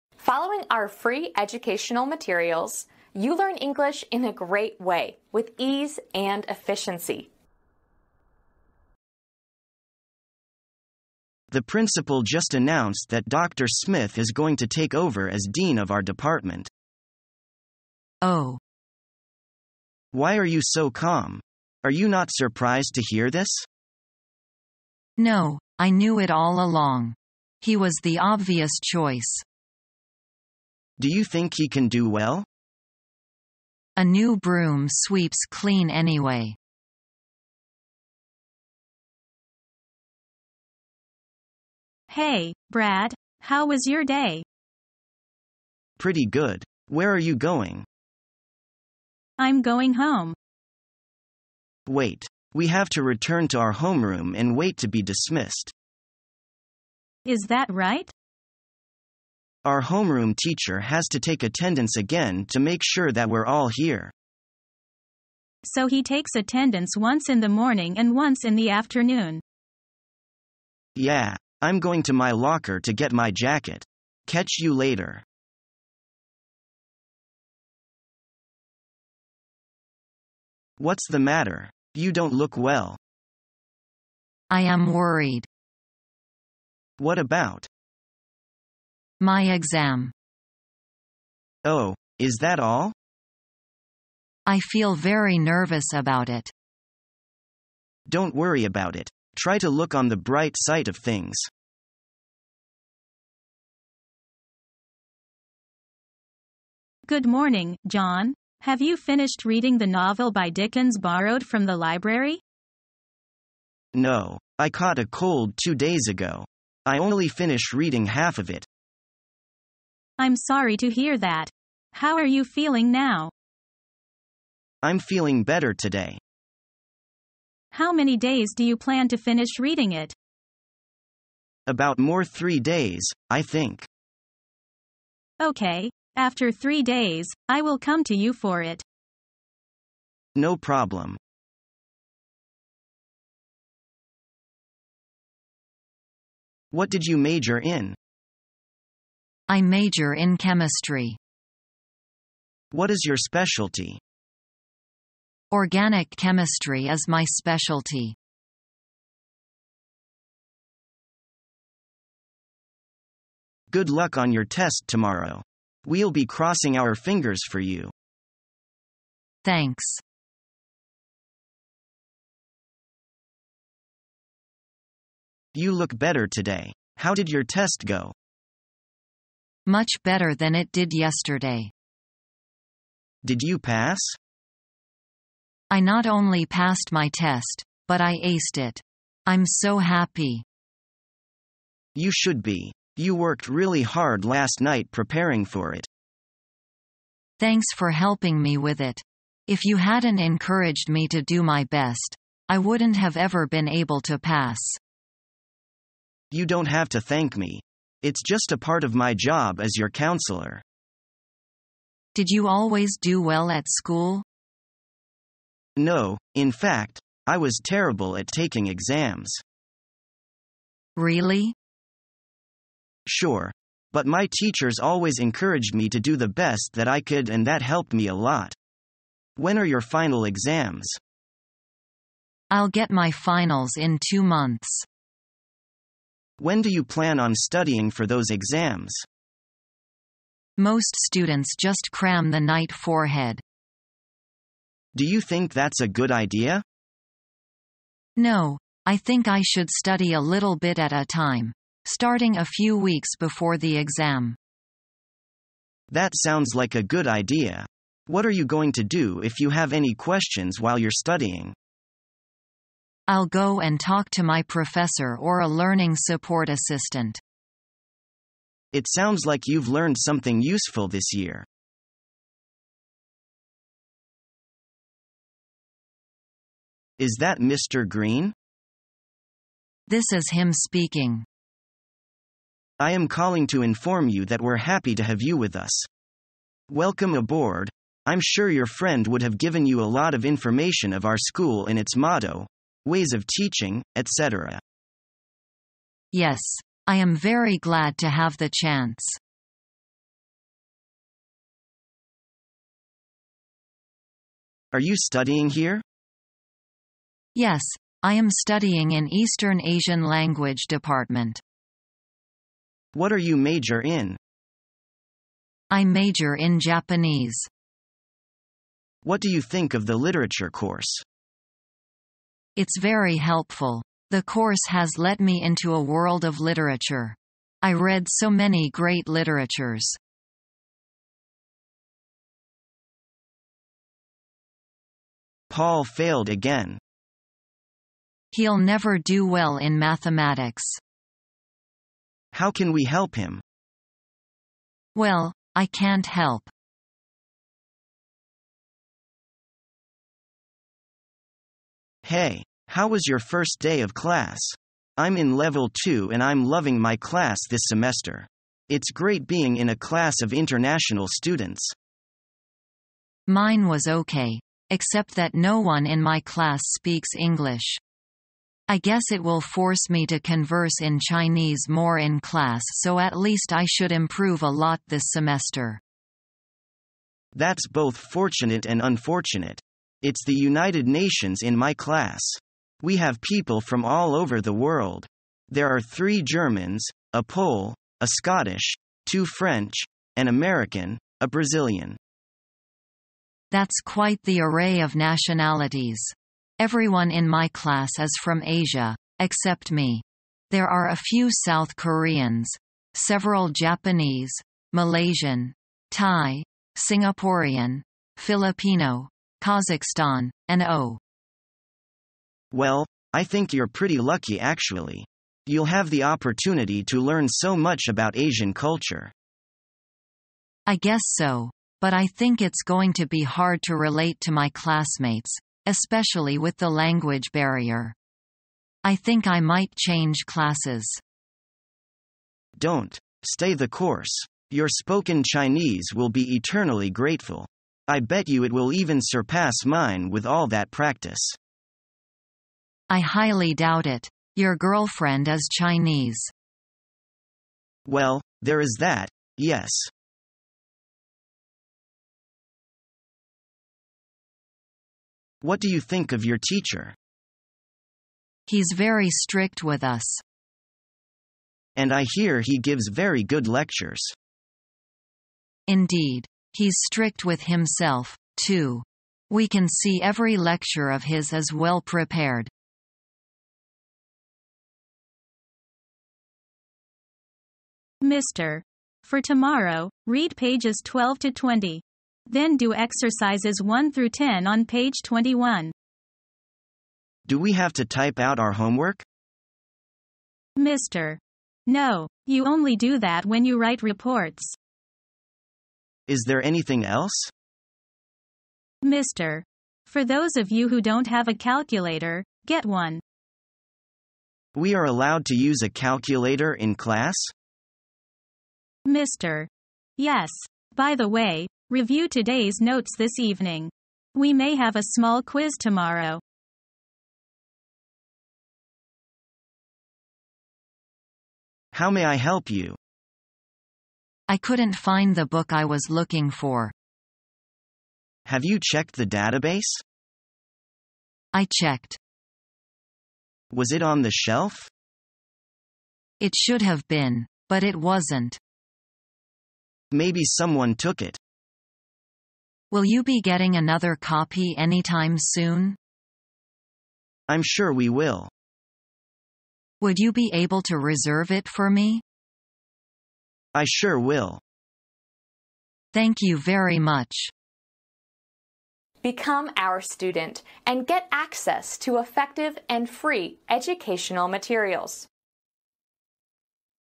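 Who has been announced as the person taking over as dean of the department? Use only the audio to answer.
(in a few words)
Dr. Smith.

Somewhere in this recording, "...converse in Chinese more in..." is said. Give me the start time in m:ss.
6:10.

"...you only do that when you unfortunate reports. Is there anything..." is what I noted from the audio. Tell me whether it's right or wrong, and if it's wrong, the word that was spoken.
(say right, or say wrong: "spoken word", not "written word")
wrong: "write", not "unfortunate".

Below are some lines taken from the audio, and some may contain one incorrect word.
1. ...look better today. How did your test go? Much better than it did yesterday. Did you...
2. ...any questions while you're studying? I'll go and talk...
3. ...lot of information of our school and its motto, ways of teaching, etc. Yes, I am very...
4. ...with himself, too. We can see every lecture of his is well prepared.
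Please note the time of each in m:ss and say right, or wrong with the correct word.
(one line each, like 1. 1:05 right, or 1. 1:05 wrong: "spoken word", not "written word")
1. 2:55 right
2. 4:19 right
3. 4:49 right
4. 7:47 right.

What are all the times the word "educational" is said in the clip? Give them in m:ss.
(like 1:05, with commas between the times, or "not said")
0:01, 9:23.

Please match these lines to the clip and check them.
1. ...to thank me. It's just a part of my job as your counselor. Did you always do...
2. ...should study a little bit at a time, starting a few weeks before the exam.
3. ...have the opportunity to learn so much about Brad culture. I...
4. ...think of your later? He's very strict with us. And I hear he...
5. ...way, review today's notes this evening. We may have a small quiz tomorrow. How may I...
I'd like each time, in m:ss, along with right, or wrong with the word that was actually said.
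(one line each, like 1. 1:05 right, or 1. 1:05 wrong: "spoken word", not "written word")
1. 3:26 right
2. 4:09 right
3. 6:55 wrong: "Asian", not "Brad"
4. 7:35 wrong: "teacher", not "later"
5. 8:31 right.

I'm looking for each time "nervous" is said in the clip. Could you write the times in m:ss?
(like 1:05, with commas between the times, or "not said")
1:35.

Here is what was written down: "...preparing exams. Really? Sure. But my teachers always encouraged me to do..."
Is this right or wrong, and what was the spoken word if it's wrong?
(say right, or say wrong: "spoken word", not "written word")
wrong: "taking", not "preparing".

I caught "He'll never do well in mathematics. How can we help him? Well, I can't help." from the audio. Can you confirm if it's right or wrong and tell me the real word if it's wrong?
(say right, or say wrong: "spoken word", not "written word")
right.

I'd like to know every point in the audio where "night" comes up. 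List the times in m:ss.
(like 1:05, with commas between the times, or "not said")
3:14, 4:02.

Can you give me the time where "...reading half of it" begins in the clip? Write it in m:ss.
1:57.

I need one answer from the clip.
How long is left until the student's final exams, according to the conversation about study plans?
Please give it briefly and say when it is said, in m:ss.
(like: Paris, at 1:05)
2 months, at 3:54.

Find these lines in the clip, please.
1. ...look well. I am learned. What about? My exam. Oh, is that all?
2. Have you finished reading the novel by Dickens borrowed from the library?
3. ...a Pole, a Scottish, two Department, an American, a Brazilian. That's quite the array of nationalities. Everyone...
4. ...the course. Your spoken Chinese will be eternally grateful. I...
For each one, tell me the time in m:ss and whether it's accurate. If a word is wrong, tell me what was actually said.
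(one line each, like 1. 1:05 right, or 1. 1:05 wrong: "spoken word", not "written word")
1. 1:22 wrong: "worried", not "learned"
2. 1:48 right
3. 6:27 wrong: "French", not "Department"
4. 7:13 right.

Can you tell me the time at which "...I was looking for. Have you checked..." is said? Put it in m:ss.
8:45.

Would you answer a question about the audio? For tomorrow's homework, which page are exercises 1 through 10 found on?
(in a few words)
21.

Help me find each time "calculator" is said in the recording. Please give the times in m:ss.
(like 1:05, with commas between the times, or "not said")
8:21, 8:25.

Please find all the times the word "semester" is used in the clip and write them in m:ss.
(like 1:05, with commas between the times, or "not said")
5:57, 6:15.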